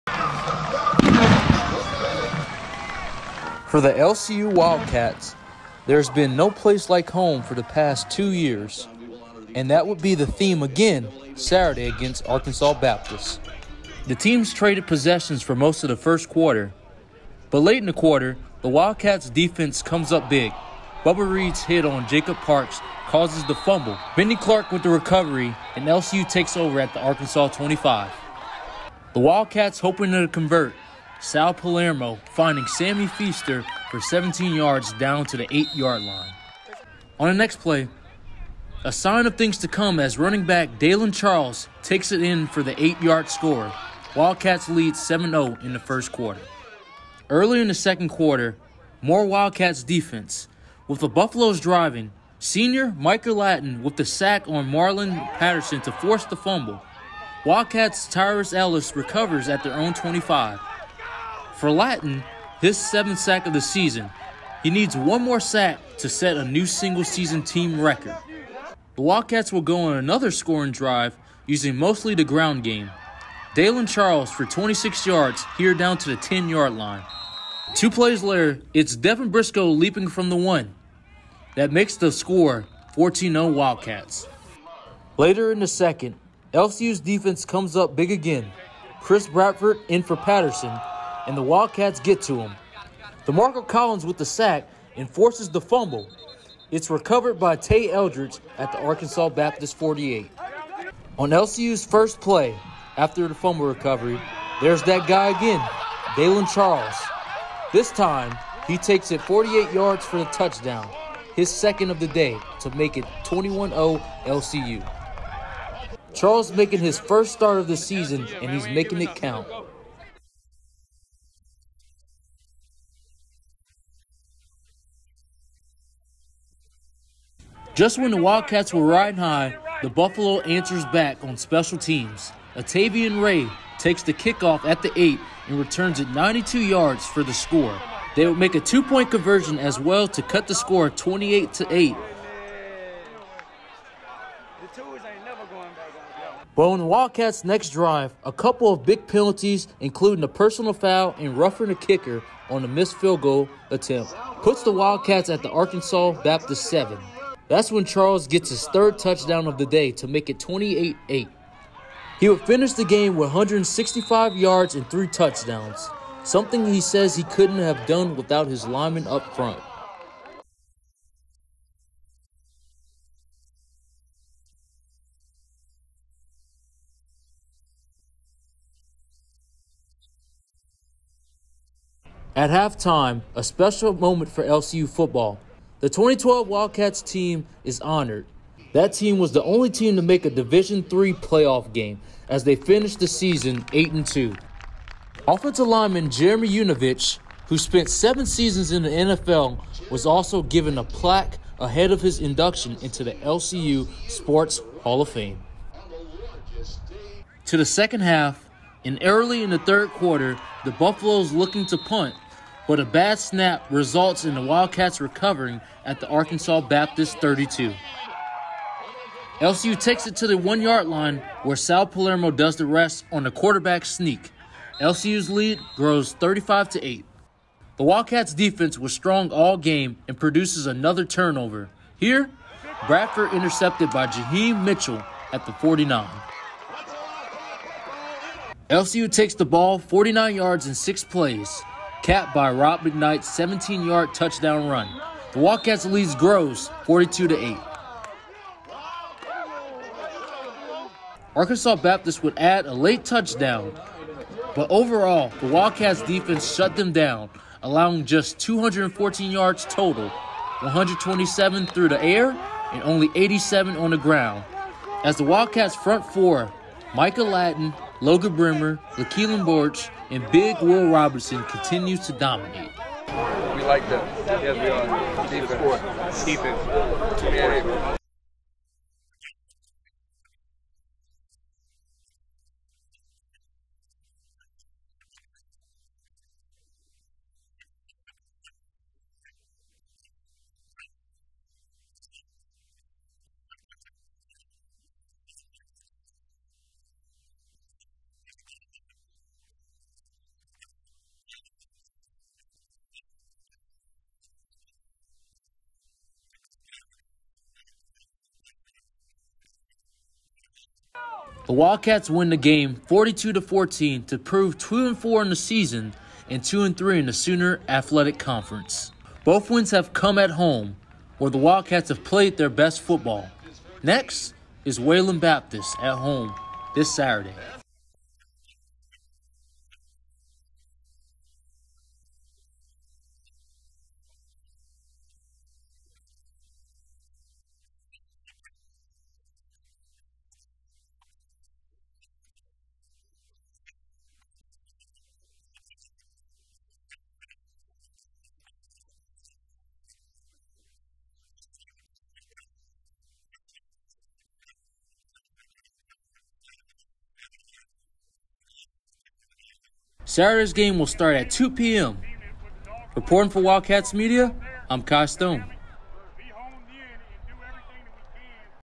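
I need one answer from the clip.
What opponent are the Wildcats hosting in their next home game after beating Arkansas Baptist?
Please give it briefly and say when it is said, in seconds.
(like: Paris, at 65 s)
Wayland Baptist, at 324 s.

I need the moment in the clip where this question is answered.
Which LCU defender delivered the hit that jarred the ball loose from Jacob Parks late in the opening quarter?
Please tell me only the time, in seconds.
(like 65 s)
21 s.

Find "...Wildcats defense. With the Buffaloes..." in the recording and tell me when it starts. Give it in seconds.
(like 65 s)
49 s.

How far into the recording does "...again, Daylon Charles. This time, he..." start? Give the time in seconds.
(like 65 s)
105 s.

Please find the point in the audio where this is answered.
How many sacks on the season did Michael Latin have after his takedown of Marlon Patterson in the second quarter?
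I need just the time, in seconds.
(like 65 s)
62 s.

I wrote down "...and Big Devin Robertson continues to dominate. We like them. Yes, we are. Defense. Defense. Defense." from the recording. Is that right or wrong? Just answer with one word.
wrong.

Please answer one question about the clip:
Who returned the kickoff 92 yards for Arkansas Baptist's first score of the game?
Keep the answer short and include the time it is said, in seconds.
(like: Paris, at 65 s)
Atavian Ray, at 132 s.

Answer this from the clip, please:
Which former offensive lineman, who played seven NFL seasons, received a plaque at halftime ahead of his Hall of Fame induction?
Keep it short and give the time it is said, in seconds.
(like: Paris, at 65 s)
Jeremy Unovich, at 196 s.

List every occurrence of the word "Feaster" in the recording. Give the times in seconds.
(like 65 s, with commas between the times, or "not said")
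33 s.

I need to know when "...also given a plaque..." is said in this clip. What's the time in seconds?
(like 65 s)
200 s.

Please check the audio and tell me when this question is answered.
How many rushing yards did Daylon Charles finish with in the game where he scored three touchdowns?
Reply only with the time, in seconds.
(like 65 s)
163 s.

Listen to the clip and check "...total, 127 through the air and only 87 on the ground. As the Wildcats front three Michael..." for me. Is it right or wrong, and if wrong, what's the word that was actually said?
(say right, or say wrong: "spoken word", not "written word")
wrong: "four", not "three".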